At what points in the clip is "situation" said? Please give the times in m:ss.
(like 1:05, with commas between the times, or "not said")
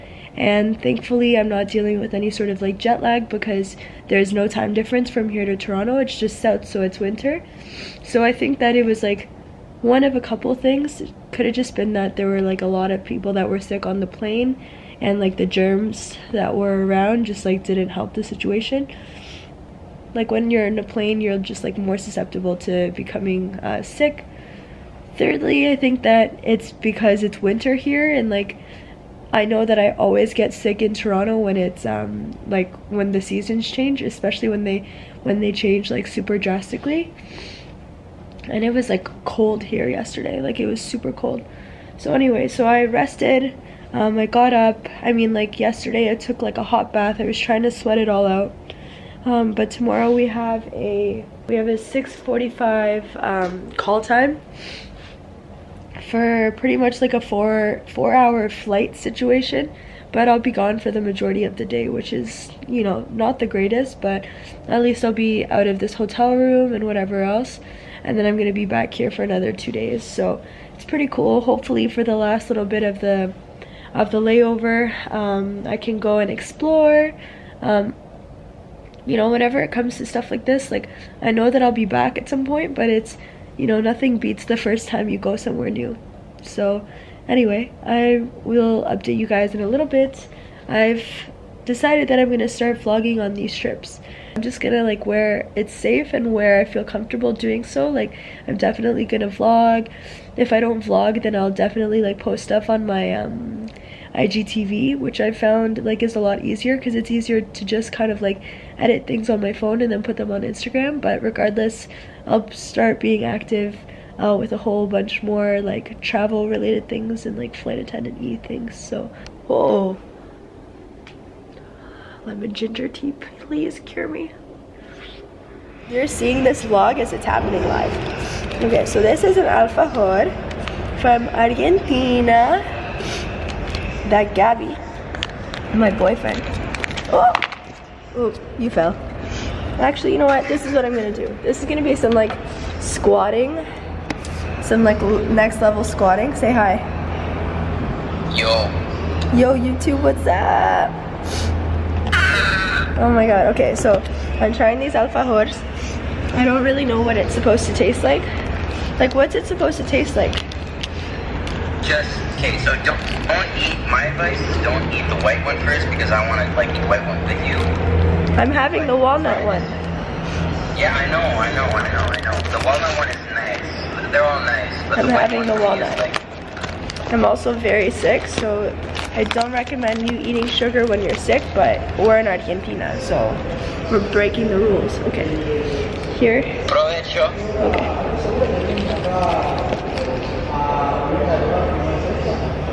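0:18, 0:58.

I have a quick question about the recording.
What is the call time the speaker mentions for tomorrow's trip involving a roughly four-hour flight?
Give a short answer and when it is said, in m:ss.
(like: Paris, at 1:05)
6:45, at 0:51.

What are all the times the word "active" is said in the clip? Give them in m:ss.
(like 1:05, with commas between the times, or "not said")
1:53.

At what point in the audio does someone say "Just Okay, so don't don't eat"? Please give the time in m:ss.
2:41.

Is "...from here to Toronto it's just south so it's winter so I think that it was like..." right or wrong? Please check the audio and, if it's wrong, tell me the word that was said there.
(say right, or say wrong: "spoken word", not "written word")
right.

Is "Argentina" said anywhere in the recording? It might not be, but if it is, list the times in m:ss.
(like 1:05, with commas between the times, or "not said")
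2:11, 3:02.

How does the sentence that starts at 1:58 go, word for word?
So, oh, lemon ginger tea, please cure me.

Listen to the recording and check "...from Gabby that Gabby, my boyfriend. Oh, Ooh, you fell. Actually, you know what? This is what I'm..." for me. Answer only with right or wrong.
wrong.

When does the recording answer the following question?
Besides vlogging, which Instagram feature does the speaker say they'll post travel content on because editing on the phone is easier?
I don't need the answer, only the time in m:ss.
1:44.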